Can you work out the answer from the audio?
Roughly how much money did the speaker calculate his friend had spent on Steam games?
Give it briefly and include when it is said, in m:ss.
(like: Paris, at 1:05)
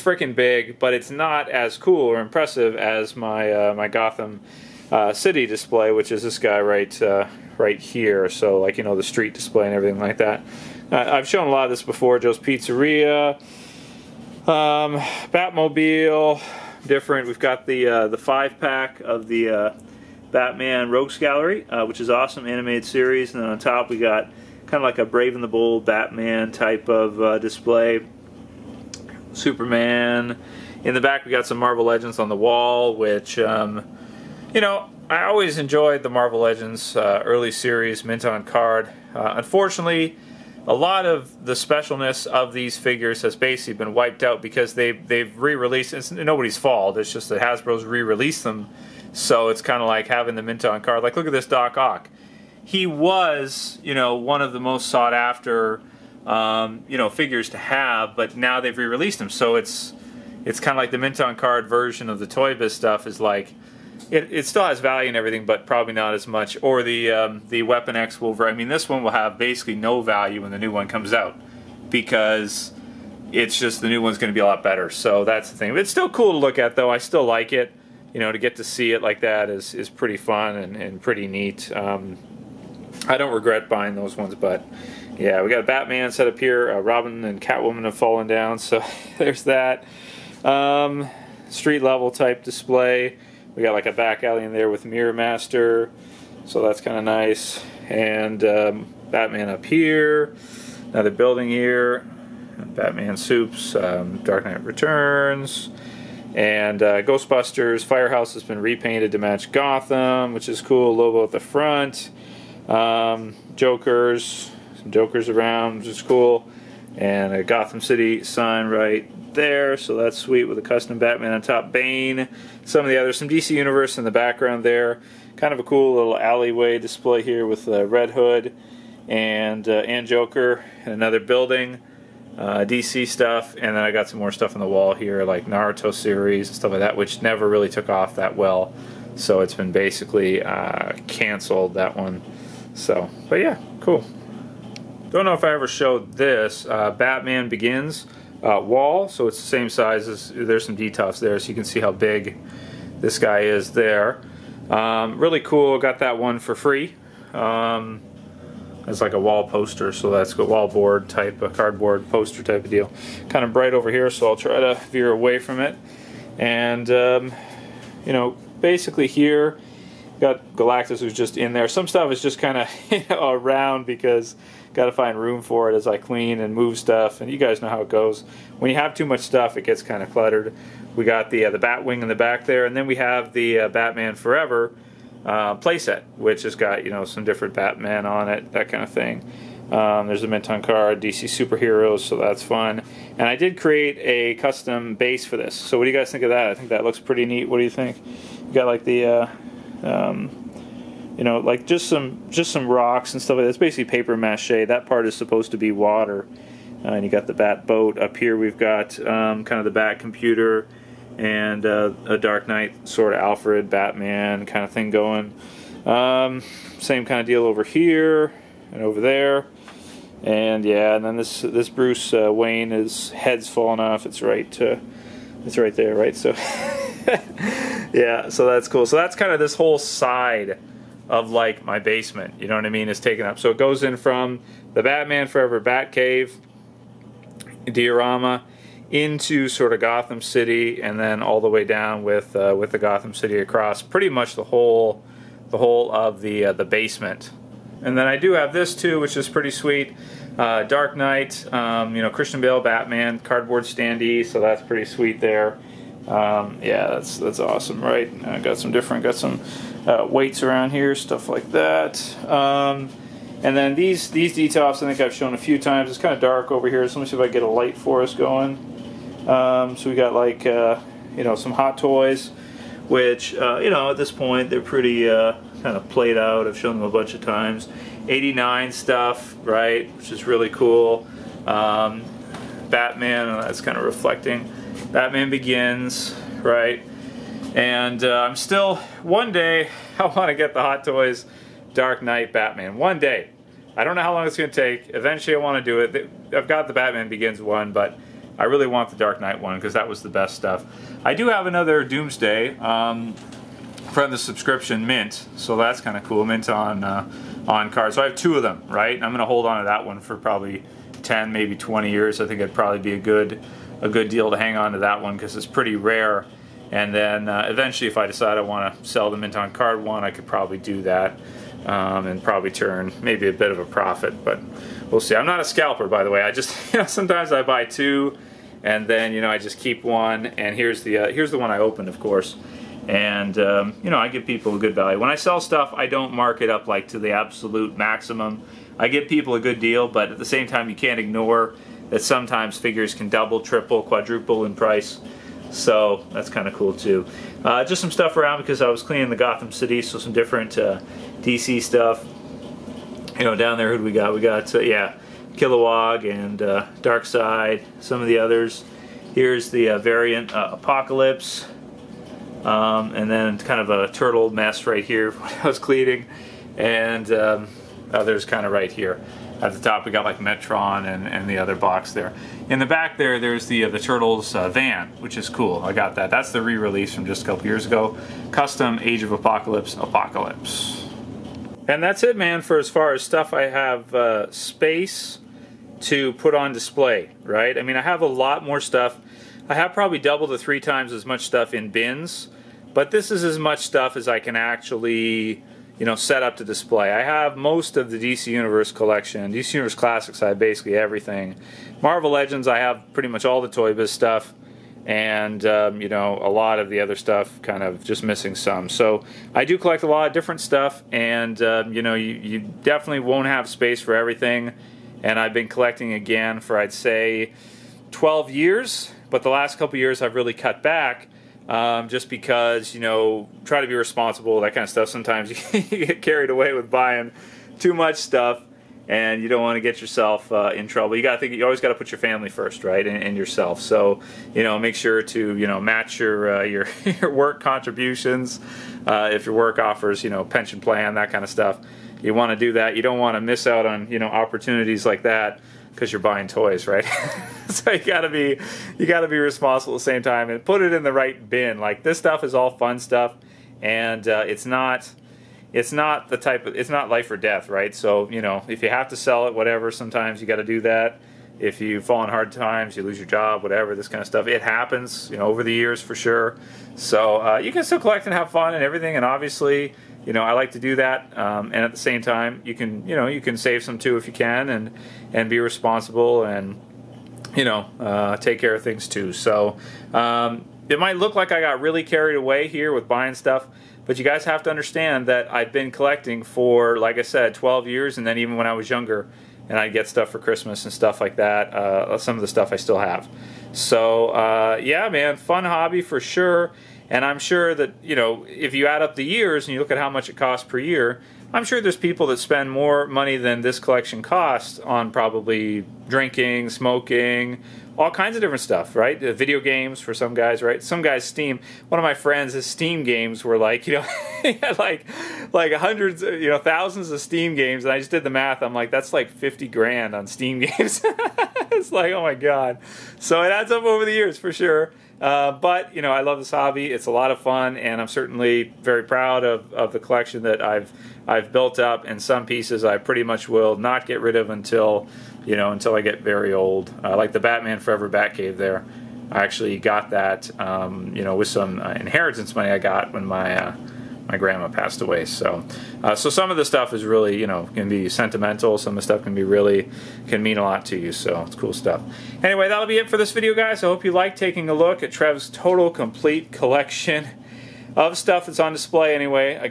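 50 grand, at 8:39.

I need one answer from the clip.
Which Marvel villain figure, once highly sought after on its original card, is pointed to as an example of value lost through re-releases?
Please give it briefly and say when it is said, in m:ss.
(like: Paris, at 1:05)
Doc Ock, at 0:51.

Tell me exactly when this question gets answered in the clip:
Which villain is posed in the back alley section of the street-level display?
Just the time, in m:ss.
1:34.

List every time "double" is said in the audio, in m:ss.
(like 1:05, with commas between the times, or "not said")
5:43, 6:29.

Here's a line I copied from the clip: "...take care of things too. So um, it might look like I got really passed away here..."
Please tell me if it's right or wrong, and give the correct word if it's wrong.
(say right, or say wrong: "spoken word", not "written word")
wrong: "carried", not "passed".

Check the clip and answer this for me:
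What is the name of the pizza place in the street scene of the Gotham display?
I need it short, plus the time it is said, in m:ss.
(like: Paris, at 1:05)
Joe's Pizzeria, at 0:12.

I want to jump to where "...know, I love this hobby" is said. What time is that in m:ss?
8:45.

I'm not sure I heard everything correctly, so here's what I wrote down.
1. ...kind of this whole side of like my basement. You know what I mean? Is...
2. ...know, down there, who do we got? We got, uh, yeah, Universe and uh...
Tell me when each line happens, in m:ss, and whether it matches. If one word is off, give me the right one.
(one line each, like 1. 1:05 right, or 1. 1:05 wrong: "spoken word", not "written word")
1. 3:49 right
2. 5:53 wrong: "Kilowog", not "Universe".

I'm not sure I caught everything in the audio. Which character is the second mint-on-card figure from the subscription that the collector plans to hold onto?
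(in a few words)
Doomsday.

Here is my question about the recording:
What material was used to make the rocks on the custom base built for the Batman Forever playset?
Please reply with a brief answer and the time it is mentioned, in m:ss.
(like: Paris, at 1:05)
Paper mache, at 3:23.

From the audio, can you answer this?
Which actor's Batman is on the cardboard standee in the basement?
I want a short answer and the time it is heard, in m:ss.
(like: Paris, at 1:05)
Christian Bale, at 4:12.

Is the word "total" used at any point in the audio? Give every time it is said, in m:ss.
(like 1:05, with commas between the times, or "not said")
9:15.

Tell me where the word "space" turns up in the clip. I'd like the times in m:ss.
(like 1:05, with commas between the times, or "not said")
6:24, 6:53.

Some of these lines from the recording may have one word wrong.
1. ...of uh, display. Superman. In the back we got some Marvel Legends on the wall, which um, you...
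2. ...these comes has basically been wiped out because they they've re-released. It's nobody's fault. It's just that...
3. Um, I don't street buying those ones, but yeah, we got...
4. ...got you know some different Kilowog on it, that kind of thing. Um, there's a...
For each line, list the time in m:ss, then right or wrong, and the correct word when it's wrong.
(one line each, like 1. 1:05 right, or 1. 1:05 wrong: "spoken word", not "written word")
1. 0:26 right
2. 0:42 wrong: "figures", not "comes"
3. 1:21 wrong: "regret", not "street"
4. 3:06 wrong: "Batman", not "Kilowog".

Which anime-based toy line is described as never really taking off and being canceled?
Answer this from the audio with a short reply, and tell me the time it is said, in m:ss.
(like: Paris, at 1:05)
Naruto, at 2:15.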